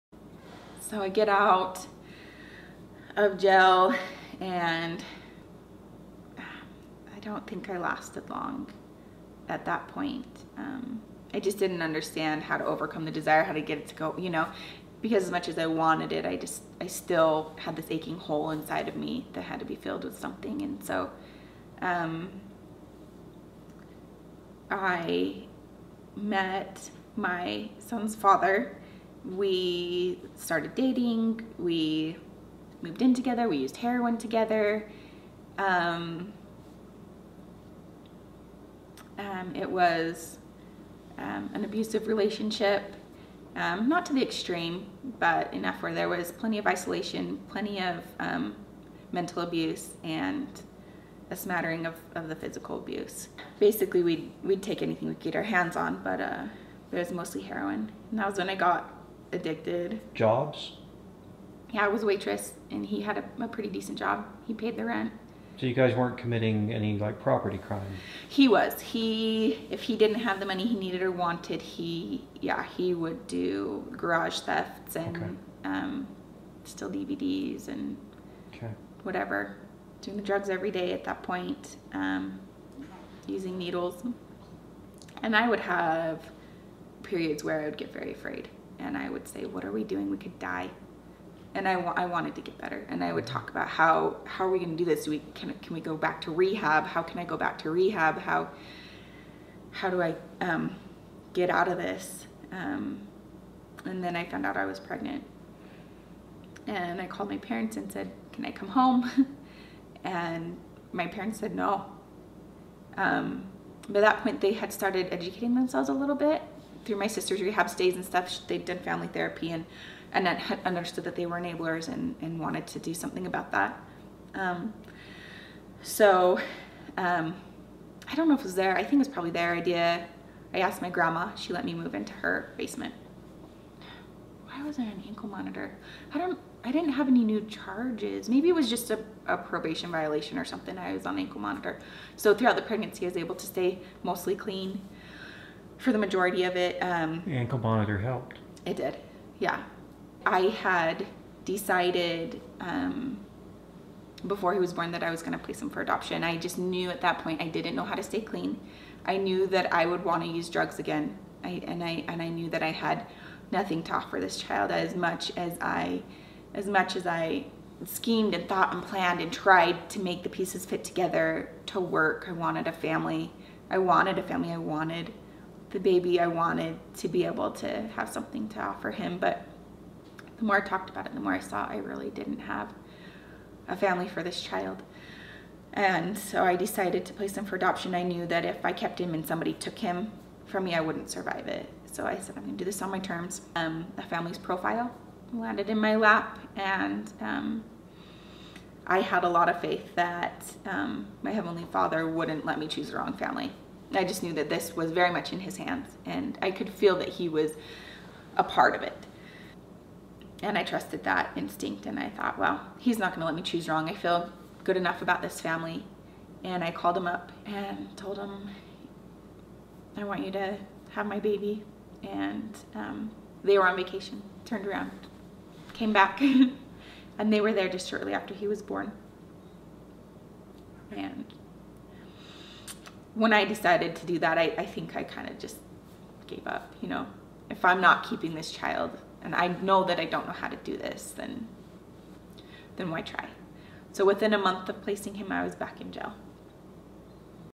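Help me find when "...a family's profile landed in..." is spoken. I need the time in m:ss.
3:13.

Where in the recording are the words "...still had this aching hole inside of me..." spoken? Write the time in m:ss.
0:16.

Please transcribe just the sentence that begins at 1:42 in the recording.
Um, and then I found out I was pregnant.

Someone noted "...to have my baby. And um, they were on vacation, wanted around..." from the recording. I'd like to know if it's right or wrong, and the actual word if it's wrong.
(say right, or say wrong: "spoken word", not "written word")
wrong: "turned", not "wanted".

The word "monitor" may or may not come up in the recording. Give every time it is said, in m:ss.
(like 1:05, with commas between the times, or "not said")
2:15, 2:21, 2:27.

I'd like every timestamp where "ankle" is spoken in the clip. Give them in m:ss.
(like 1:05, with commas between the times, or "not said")
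2:15, 2:21, 2:27.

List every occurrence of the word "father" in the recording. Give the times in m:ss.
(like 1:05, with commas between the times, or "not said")
0:28, 3:21.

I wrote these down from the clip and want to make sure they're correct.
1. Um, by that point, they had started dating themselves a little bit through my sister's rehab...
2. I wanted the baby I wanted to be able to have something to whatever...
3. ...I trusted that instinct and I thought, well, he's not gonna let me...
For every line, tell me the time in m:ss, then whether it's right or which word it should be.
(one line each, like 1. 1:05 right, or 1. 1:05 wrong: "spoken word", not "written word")
1. 1:52 wrong: "educating", not "dating"
2. 2:54 wrong: "offer", not "whatever"
3. 3:30 right.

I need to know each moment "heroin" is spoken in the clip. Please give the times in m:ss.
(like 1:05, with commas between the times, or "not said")
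0:33, 0:57.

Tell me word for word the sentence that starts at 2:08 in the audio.
I think it was probably their idea.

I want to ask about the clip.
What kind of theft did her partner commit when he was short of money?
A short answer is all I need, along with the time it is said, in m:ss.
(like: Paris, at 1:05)
garage thefts, at 1:13.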